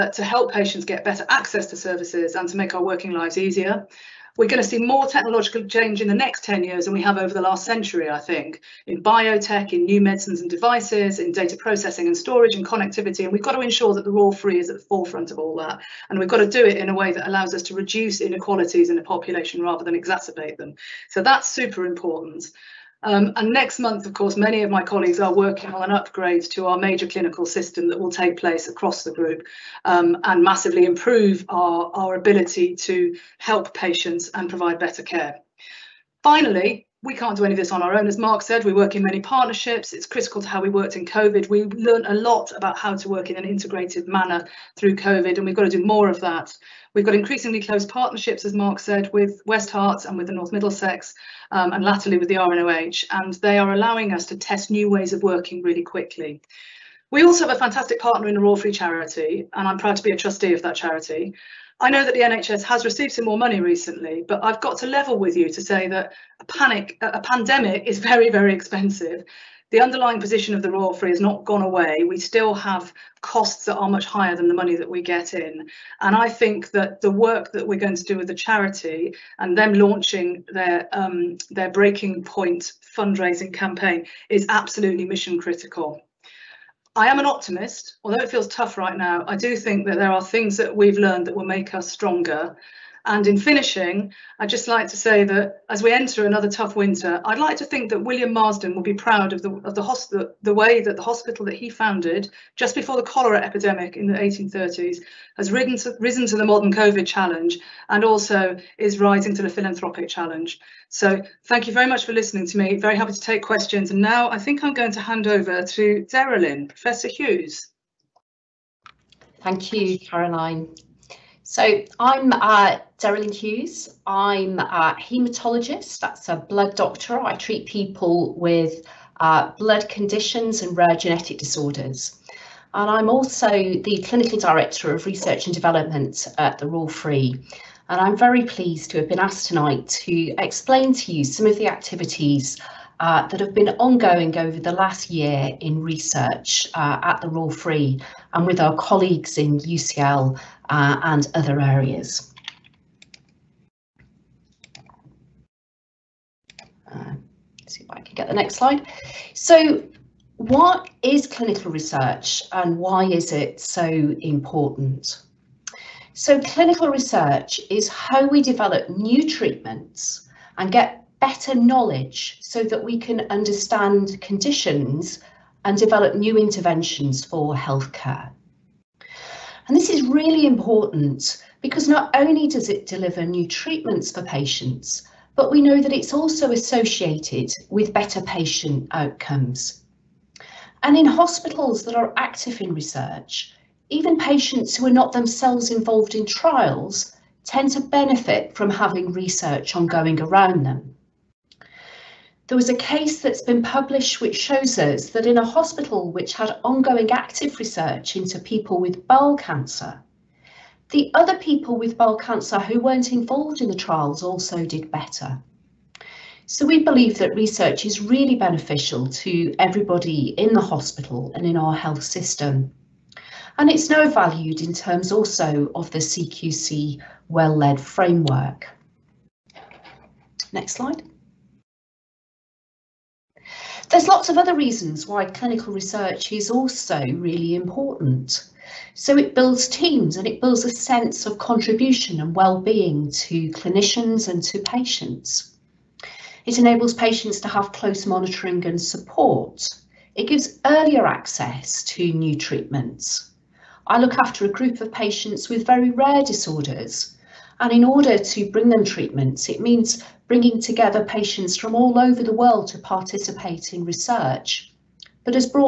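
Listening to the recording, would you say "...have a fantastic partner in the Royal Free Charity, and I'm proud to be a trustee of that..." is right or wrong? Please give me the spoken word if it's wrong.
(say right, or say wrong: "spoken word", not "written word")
right.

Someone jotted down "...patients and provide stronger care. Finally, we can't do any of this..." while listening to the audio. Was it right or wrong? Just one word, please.
wrong.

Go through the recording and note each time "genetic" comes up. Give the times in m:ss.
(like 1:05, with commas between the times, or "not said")
2:10.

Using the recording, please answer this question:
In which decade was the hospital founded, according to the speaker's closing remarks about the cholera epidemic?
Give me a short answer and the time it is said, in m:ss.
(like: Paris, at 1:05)
1830s, at 1:44.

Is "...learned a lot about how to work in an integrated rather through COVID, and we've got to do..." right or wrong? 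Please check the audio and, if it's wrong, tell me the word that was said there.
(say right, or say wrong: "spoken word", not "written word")
wrong: "manner", not "rather".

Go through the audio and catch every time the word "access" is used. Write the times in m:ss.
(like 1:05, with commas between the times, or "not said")
0:01, 4:11.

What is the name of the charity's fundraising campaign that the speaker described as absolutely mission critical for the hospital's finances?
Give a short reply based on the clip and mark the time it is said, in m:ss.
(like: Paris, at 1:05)
Breaking Point, at 1:21.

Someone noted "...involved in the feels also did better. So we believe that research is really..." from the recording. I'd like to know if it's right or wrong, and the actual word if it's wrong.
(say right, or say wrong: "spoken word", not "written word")
wrong: "trials", not "feels".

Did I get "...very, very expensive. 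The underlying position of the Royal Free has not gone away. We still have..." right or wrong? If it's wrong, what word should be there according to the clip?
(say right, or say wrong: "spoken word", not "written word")
right.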